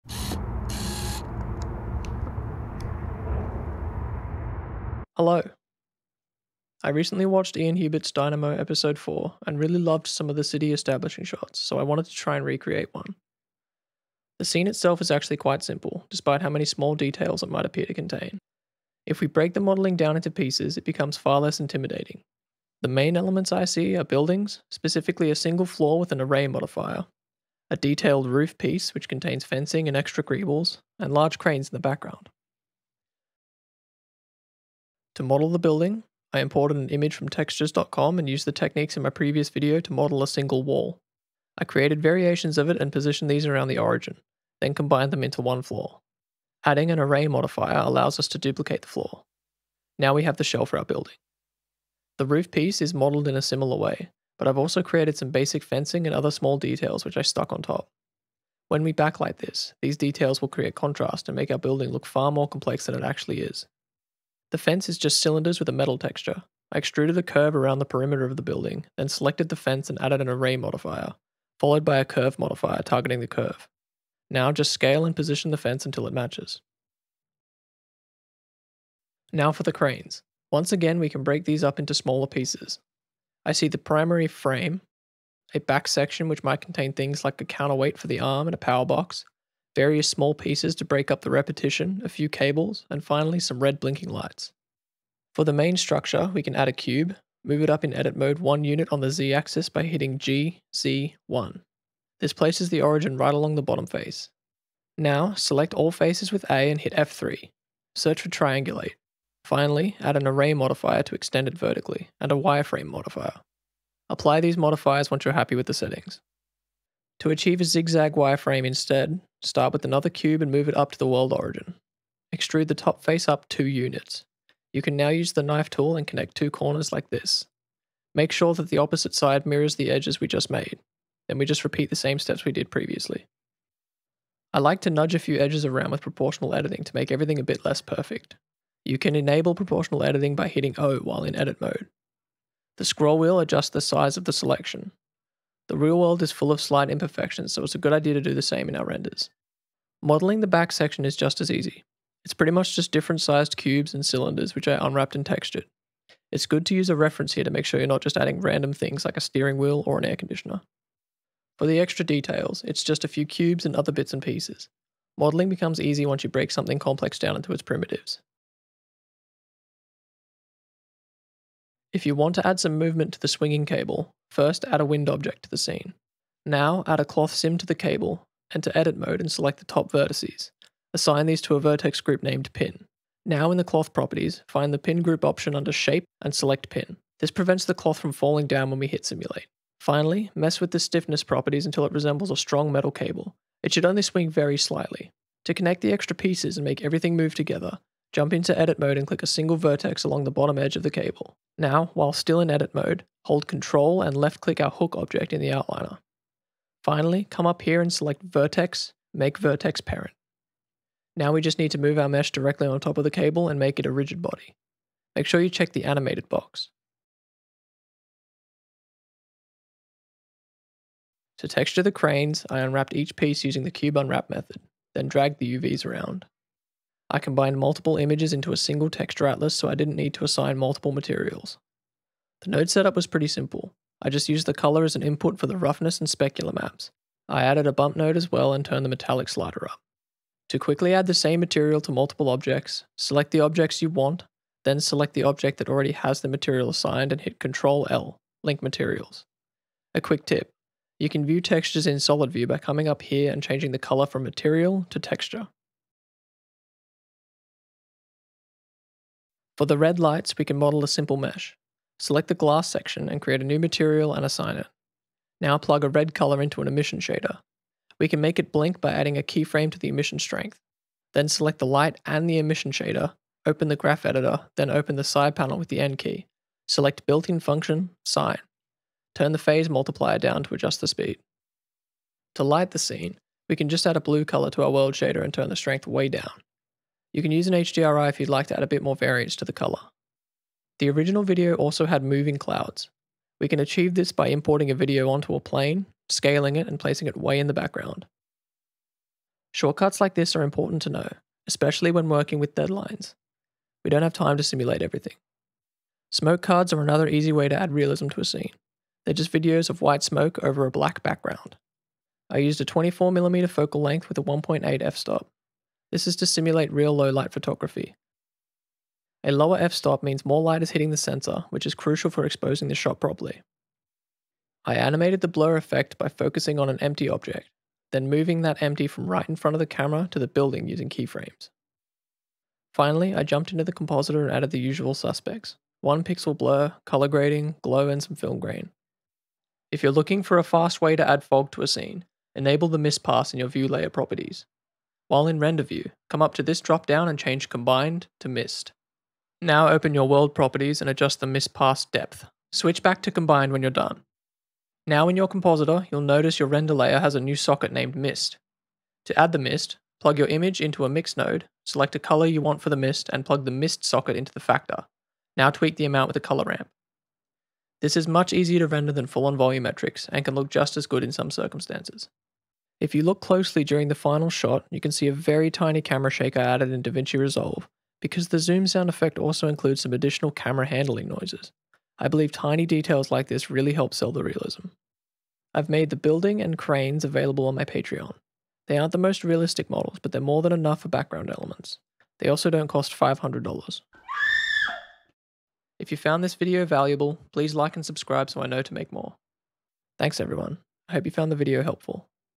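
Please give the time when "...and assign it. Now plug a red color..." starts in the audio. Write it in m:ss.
4:24.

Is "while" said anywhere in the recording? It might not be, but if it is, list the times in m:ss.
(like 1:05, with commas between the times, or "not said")
2:20, 3:21, 5:45.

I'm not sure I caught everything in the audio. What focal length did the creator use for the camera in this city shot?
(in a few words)
24mm.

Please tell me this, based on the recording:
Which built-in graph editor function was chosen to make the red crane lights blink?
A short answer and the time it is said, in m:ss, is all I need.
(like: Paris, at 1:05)
sine, at 4:38.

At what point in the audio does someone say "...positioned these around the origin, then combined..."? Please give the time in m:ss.
0:42.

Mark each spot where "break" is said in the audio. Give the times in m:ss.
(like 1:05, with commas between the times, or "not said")
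0:19, 1:21, 1:30, 2:46.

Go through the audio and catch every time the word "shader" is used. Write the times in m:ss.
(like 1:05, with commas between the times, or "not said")
4:26, 4:32, 4:44.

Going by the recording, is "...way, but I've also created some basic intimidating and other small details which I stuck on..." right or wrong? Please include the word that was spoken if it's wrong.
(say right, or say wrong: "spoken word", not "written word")
wrong: "fencing", not "intimidating".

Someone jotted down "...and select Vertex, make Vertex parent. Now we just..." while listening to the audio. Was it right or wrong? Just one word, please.
right.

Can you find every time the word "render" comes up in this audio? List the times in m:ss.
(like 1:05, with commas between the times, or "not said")
2:28, 5:45, 5:56, 6:08.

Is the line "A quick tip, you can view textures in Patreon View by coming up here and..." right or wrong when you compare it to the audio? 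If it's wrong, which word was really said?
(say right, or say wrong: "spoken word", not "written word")
wrong: "Solid", not "Patreon".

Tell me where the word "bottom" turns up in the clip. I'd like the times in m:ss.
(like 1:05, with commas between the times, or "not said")
1:43, 3:20.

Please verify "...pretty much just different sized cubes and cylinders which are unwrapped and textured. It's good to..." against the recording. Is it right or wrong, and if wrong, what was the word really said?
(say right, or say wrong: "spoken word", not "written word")
right.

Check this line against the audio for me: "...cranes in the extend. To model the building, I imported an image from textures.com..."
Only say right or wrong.
wrong.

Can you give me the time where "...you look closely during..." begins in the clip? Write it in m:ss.
6:12.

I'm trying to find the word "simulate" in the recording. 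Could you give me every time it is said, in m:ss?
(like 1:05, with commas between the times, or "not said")
3:09, 5:04, 5:16.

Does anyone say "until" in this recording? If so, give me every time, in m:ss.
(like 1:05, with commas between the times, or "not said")
1:15, 3:11.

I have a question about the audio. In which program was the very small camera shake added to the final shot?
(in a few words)
DaVinci Resolve.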